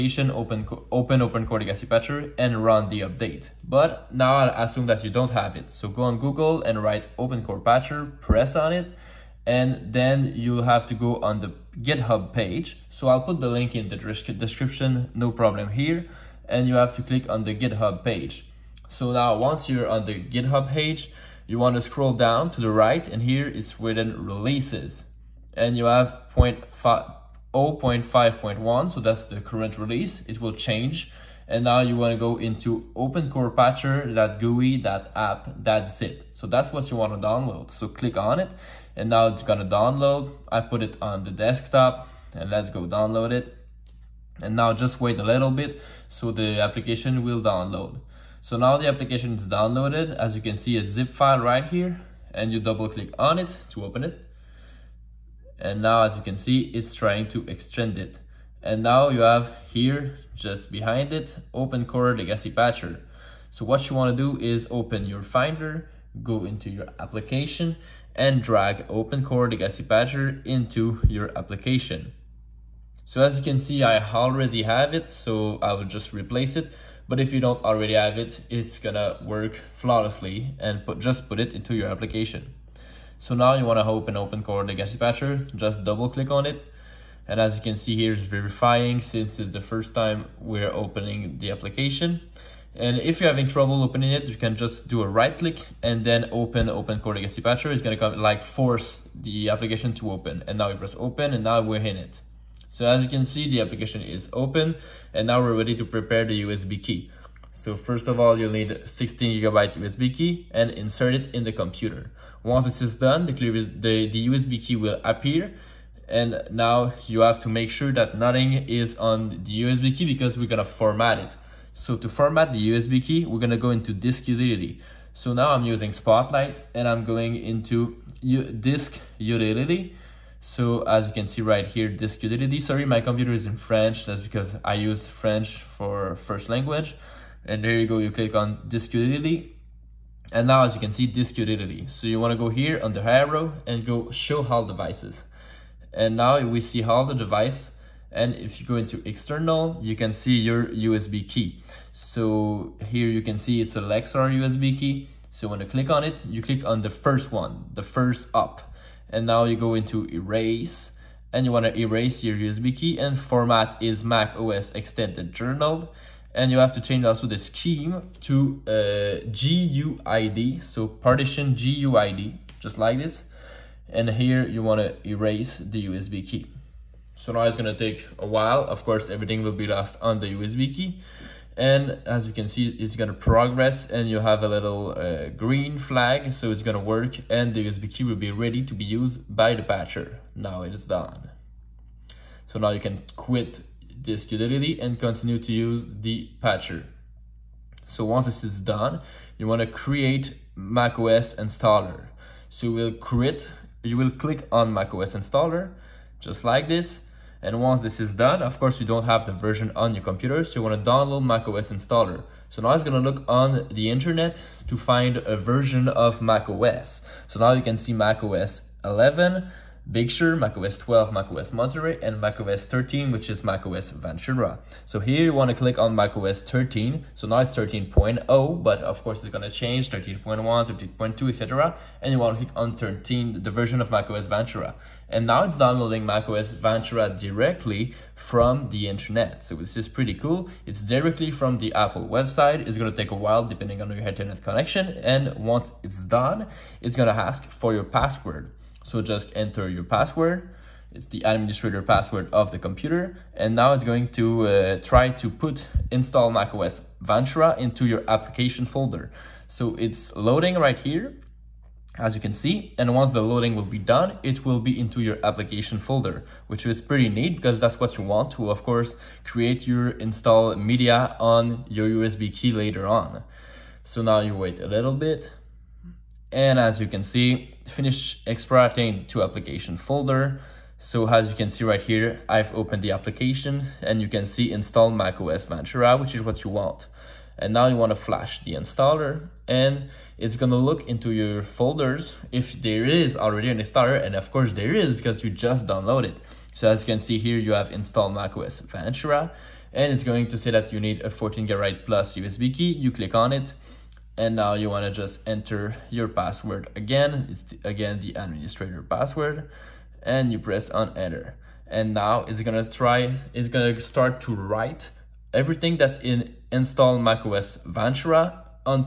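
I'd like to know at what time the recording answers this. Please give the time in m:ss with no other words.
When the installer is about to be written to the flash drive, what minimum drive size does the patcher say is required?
5:01.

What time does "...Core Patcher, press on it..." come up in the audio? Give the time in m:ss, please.
0:07.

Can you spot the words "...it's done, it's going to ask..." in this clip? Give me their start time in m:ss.
4:05.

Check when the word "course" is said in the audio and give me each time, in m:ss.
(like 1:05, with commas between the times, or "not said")
2:58, 3:28, 3:49, 4:28, 4:54.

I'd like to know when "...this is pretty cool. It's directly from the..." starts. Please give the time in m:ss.
3:59.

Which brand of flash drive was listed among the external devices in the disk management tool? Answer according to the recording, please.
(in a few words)
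Lexar.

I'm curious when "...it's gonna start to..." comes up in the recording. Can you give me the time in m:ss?
5:13.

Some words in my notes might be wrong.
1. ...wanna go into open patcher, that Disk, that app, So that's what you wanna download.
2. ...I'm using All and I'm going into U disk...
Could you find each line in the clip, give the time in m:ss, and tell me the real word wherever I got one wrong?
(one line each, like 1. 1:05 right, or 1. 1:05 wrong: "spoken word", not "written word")
1. 0:31 wrong: "GUI", not "Disk"
2. 2:05 wrong: "Spotlight", not "All".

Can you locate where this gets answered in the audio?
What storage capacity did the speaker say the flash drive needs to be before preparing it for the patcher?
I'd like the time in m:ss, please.
1:48.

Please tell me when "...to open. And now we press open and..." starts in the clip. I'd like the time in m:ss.
1:39.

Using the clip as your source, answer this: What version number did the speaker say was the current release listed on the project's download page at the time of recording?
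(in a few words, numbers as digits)
0.5.1.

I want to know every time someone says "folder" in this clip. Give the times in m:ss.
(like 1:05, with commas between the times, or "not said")
4:18, 4:25, 4:39, 4:51.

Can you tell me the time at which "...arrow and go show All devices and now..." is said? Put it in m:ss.
2:23.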